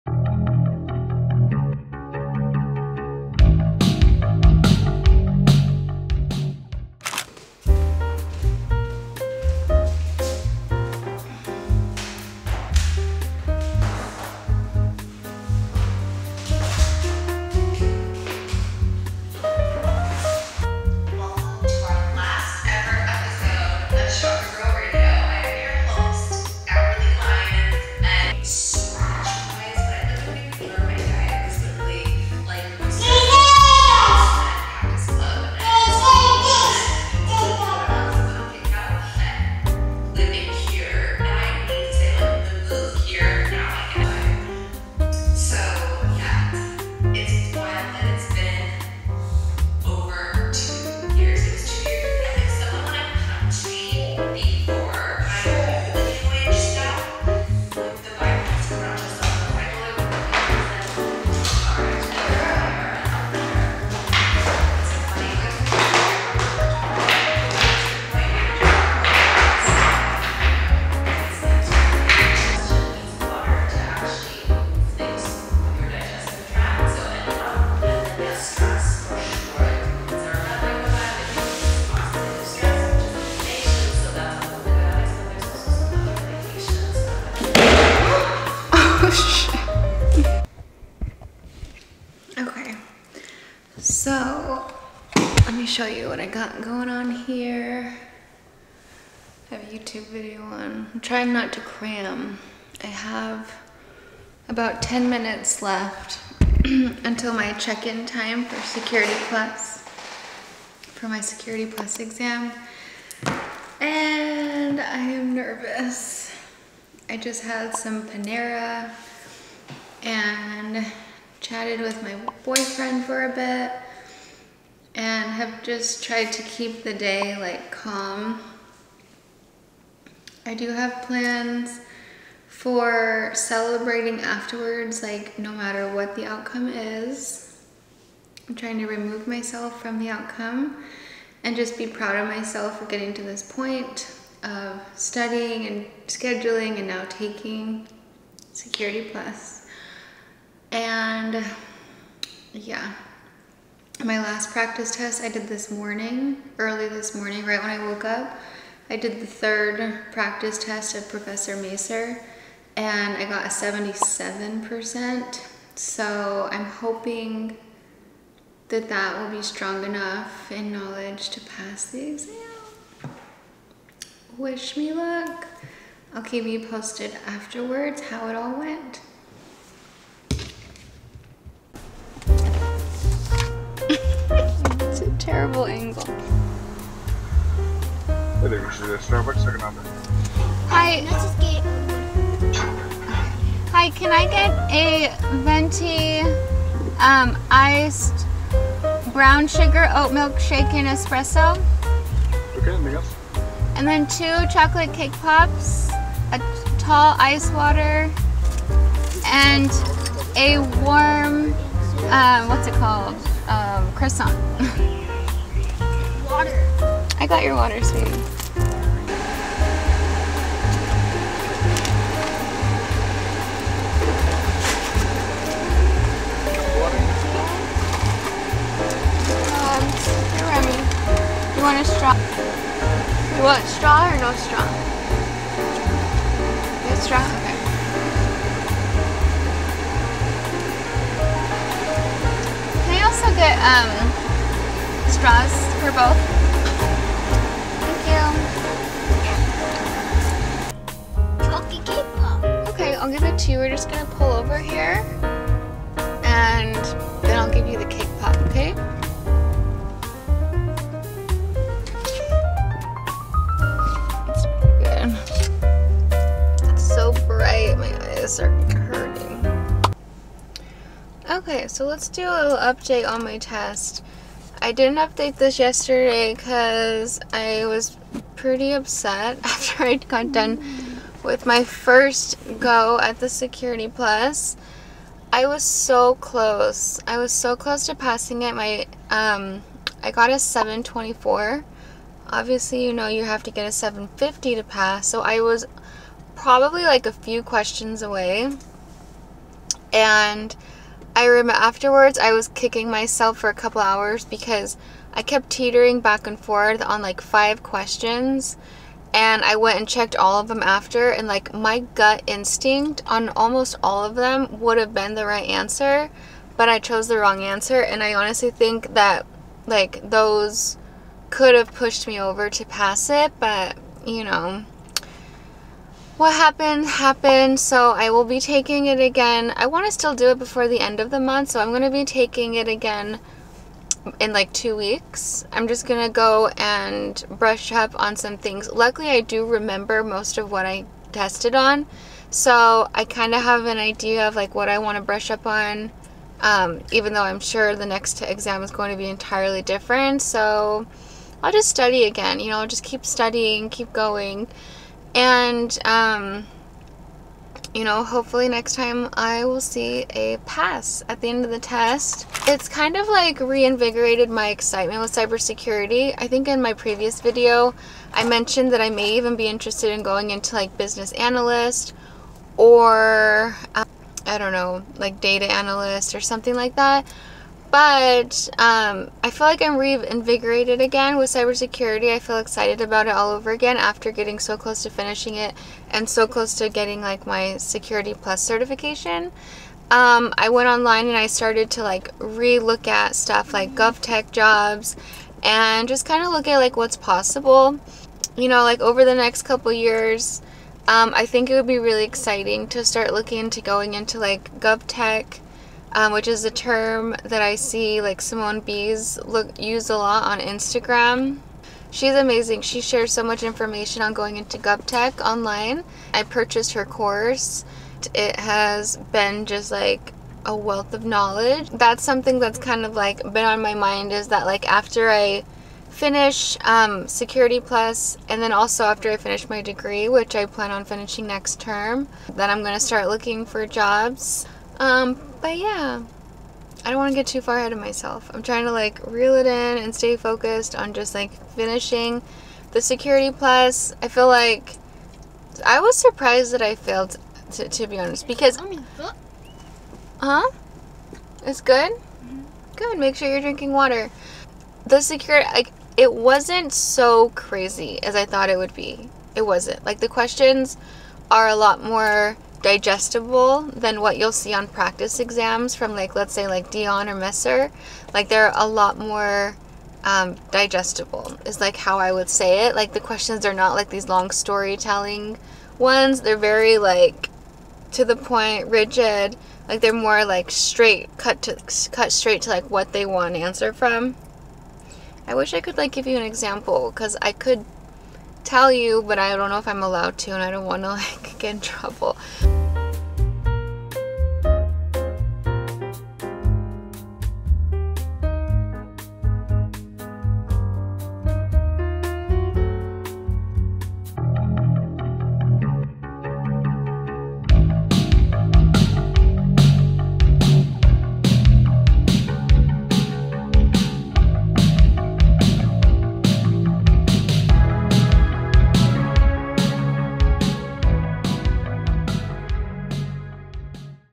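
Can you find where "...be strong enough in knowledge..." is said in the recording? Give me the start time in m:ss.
2:49.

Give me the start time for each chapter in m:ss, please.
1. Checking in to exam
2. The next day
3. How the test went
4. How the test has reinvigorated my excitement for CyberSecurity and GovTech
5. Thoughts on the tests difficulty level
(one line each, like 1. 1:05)
1. 1:30
2. 3:01
3. 4:30
4. 6:13
5. 7:06.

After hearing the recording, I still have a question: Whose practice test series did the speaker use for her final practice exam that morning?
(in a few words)
Professor Messer.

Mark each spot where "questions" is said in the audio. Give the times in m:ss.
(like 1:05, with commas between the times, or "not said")
4:57, 5:07, 7:40, 7:52.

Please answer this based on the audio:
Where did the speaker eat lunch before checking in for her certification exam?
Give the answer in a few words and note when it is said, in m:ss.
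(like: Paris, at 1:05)
Panera, at 1:58.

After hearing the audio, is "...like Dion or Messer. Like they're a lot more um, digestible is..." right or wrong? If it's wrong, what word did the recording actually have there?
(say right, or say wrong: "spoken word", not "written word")
right.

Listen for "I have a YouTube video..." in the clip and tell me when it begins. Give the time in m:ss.
1:39.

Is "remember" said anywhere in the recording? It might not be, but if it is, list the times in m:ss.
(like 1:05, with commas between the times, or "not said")
5:01, 5:39.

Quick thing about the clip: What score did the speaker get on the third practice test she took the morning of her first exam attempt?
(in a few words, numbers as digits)
77%.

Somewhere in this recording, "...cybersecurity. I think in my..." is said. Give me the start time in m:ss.
6:05.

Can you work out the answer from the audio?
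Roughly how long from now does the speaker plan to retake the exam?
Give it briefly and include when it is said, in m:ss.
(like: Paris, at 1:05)
2 weeks, at 5:34.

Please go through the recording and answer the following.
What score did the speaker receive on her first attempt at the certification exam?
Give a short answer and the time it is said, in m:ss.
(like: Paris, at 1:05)
724, at 4:50.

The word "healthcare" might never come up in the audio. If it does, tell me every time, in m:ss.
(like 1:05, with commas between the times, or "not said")
not said.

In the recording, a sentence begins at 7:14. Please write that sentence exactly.
Um, but yeah, I don't want to get too far ahead of myself.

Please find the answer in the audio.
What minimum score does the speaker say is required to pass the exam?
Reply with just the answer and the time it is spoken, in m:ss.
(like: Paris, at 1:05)
750, at 4:53.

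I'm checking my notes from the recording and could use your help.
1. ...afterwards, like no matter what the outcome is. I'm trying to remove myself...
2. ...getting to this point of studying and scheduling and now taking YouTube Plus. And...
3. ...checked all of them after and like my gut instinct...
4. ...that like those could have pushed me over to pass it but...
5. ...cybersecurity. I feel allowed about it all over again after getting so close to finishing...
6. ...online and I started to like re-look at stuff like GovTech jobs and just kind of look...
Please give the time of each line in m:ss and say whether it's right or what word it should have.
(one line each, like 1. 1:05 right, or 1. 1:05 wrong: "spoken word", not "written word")
1. 2:14 right
2. 2:22 wrong: "Security", not "YouTube"
3. 5:09 right
4. 5:18 right
5. 6:21 wrong: "excited", not "allowed"
6. 6:30 right.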